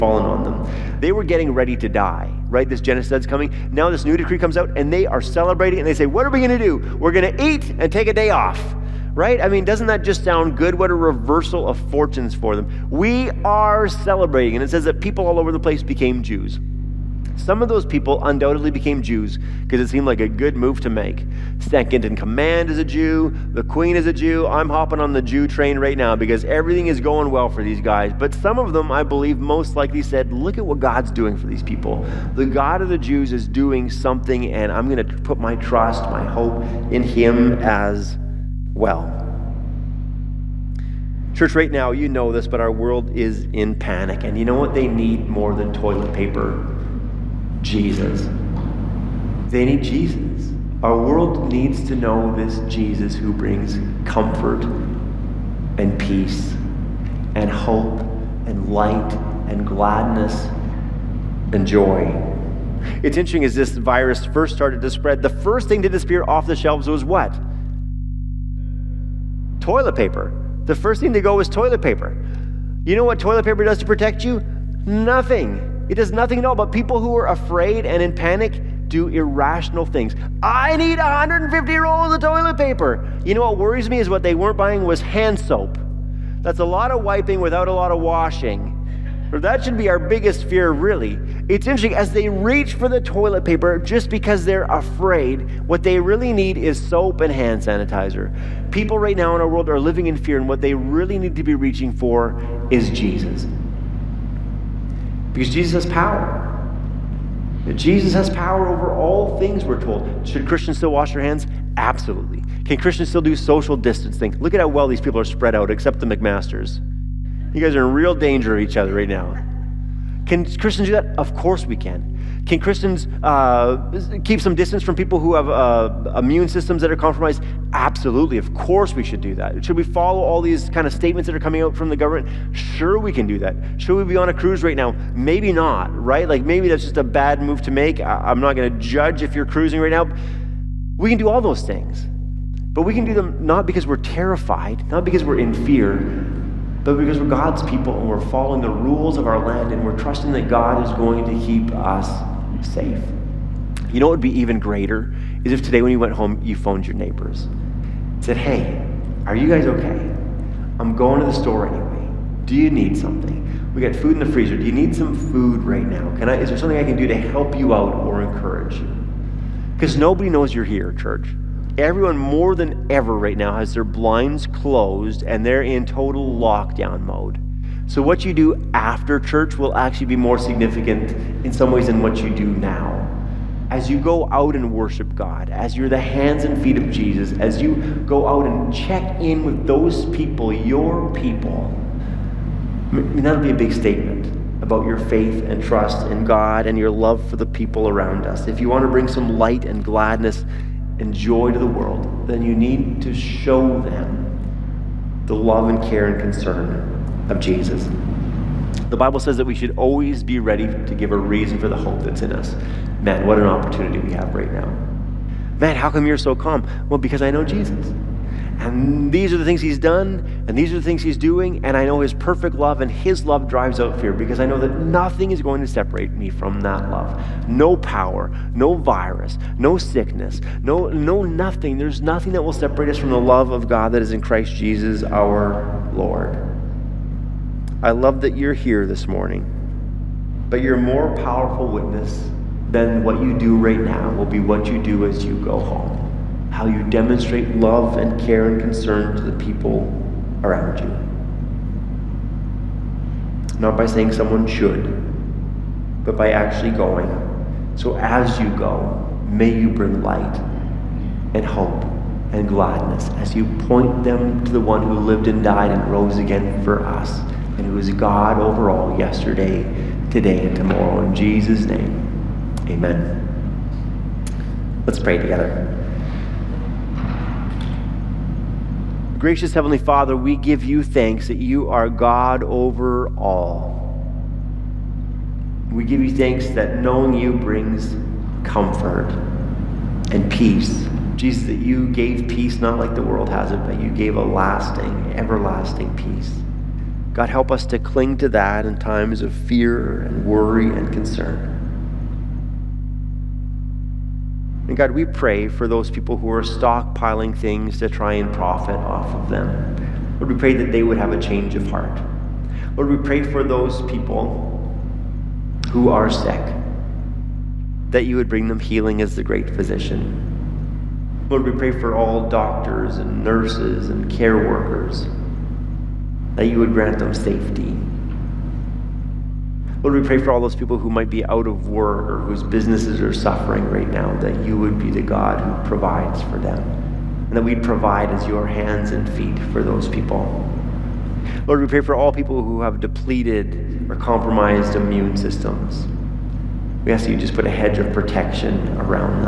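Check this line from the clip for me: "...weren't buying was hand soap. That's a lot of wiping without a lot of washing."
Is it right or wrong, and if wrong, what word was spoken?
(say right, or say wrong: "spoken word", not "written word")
right.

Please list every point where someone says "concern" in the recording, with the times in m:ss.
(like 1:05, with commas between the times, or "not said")
3:26, 4:08, 5:00.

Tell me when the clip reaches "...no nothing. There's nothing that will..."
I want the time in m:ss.
3:50.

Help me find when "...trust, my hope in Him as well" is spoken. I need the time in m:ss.
0:35.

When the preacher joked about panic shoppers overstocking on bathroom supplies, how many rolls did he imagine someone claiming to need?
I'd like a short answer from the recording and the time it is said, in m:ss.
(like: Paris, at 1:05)
150, at 1:20.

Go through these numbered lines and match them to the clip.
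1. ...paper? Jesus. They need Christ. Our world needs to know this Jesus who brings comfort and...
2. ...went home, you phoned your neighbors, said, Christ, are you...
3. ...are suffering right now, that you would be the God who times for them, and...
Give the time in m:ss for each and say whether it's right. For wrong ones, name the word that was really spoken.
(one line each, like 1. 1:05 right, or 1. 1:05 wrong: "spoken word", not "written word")
1. 0:46 wrong: "Jesus", not "Christ"
2. 2:35 wrong: "Hey", not "Christ"
3. 5:33 wrong: "provides", not "times".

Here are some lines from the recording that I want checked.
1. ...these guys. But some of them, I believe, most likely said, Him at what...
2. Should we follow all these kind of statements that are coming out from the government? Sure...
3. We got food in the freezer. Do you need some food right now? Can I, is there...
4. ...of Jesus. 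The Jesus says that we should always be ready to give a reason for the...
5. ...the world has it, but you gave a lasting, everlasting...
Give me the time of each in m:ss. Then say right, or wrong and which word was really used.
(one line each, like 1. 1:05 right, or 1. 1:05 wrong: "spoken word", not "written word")
1. 0:27 wrong: "Look", not "Him"
2. 2:09 right
3. 2:43 right
4. 3:27 wrong: "Bible", not "Jesus"
5. 4:52 right.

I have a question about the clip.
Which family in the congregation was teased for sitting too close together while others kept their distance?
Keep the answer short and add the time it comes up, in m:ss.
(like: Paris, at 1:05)
The McMasters, at 1:56.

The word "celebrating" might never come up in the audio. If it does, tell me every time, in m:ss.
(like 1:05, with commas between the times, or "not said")
0:05, 0:13.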